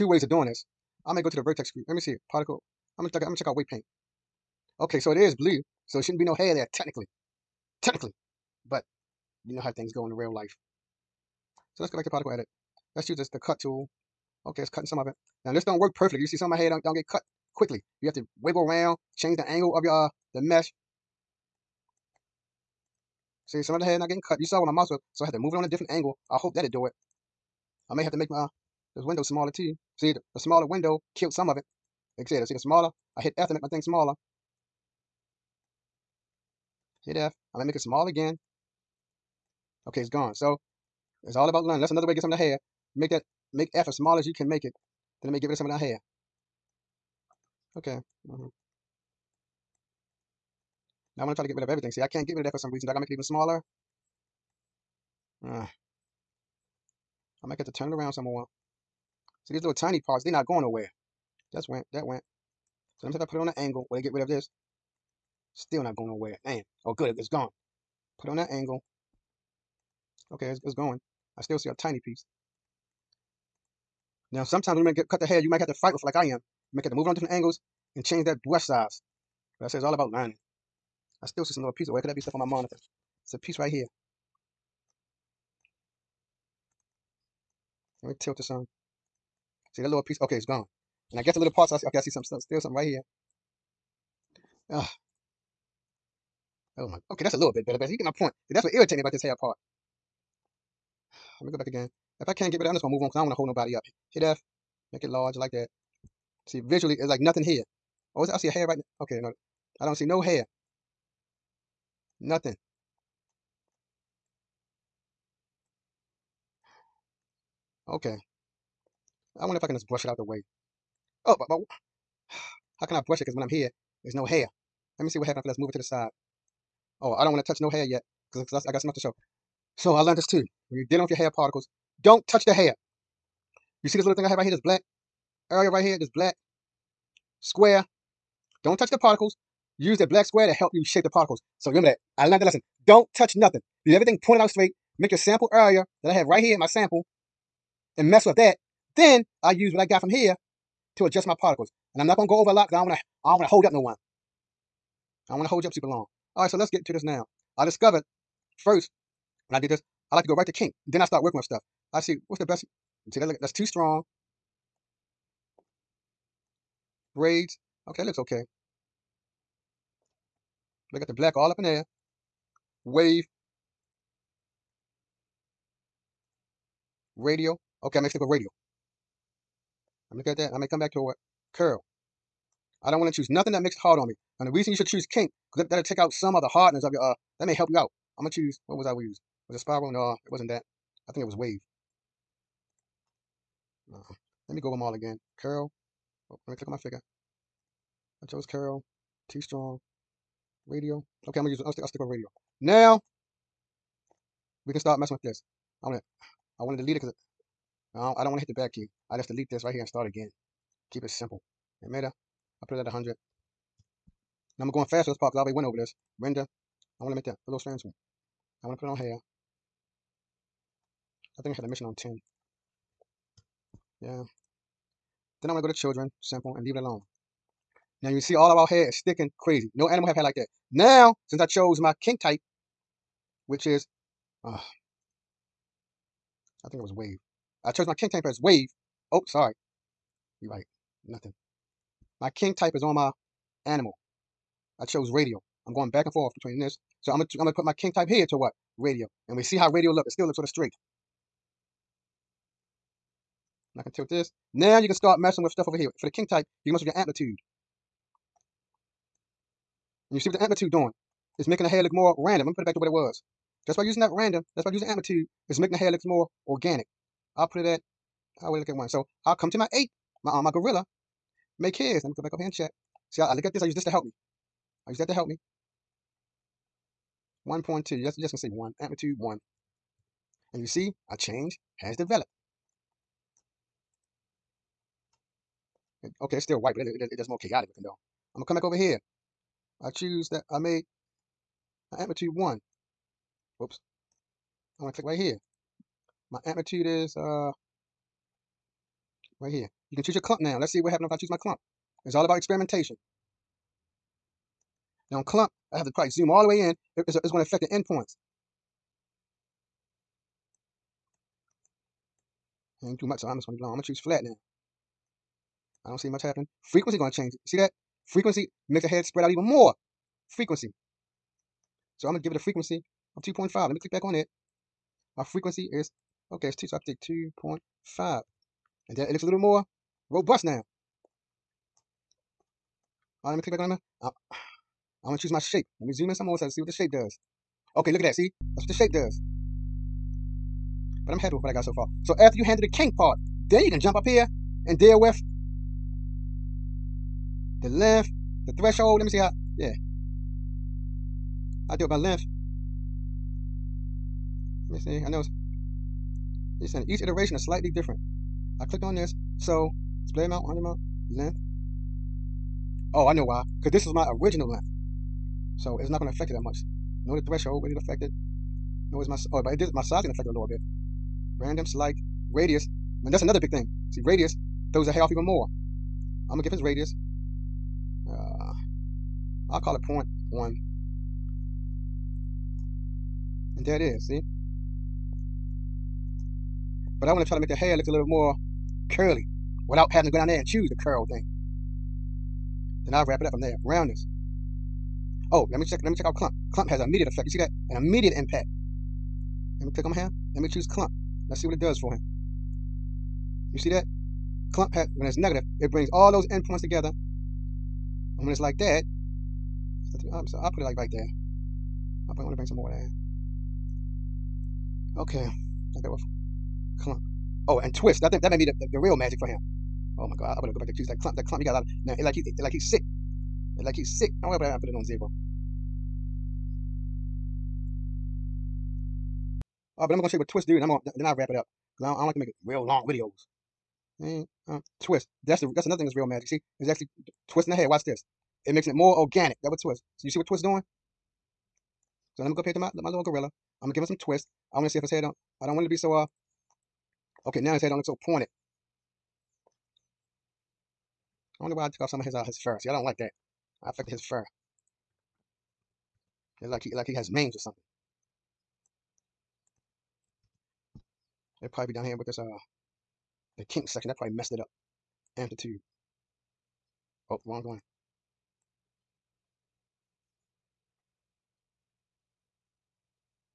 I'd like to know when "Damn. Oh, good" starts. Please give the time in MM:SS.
01:06.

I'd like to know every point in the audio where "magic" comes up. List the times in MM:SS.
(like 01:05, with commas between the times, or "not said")
06:58, 07:16.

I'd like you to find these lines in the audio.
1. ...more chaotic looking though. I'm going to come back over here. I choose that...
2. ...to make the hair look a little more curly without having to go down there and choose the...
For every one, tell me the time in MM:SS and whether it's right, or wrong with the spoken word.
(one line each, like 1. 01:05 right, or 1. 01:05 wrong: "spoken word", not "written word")
1. 04:47 right
2. 06:27 right.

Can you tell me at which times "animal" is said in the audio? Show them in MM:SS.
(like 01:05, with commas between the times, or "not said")
03:49, 04:03.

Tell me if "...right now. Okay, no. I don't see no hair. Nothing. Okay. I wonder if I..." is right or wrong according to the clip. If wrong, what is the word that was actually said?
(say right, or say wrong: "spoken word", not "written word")
right.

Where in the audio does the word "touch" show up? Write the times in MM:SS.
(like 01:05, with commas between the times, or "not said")
02:07, 02:12, 02:18, 02:23.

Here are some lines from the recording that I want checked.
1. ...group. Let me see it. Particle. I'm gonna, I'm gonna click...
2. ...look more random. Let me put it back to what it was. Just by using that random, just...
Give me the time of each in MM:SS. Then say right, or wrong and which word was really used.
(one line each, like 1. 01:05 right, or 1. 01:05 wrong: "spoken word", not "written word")
1. 00:01 wrong: "check", not "click"
2. 04:21 right.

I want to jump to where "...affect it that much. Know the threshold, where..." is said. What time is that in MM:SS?
06:06.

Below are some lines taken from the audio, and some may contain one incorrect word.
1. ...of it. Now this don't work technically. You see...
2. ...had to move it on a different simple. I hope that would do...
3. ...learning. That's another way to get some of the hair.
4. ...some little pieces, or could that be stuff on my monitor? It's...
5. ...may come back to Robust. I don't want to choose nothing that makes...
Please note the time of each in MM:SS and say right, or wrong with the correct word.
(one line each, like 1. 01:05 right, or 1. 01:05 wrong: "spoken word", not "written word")
1. 00:14 wrong: "perfectly", not "technically"
2. 00:25 wrong: "angle", not "simple"
3. 00:41 right
4. 01:21 right
5. 03:00 wrong: "Curl", not "Robust".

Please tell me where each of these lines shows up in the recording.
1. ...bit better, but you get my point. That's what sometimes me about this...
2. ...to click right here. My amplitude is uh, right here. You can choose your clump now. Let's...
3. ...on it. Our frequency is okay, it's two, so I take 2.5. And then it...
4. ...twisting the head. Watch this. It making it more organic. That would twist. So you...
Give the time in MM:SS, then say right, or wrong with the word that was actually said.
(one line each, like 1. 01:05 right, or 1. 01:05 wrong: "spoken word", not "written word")
1. 01:37 wrong: "irritates", not "sometimes"
2. 04:54 right
3. 05:24 right
4. 07:17 right.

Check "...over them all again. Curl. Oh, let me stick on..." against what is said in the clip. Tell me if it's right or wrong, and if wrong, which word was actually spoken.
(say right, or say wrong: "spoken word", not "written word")
wrong: "click", not "stick".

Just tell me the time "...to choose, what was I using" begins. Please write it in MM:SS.
03:08.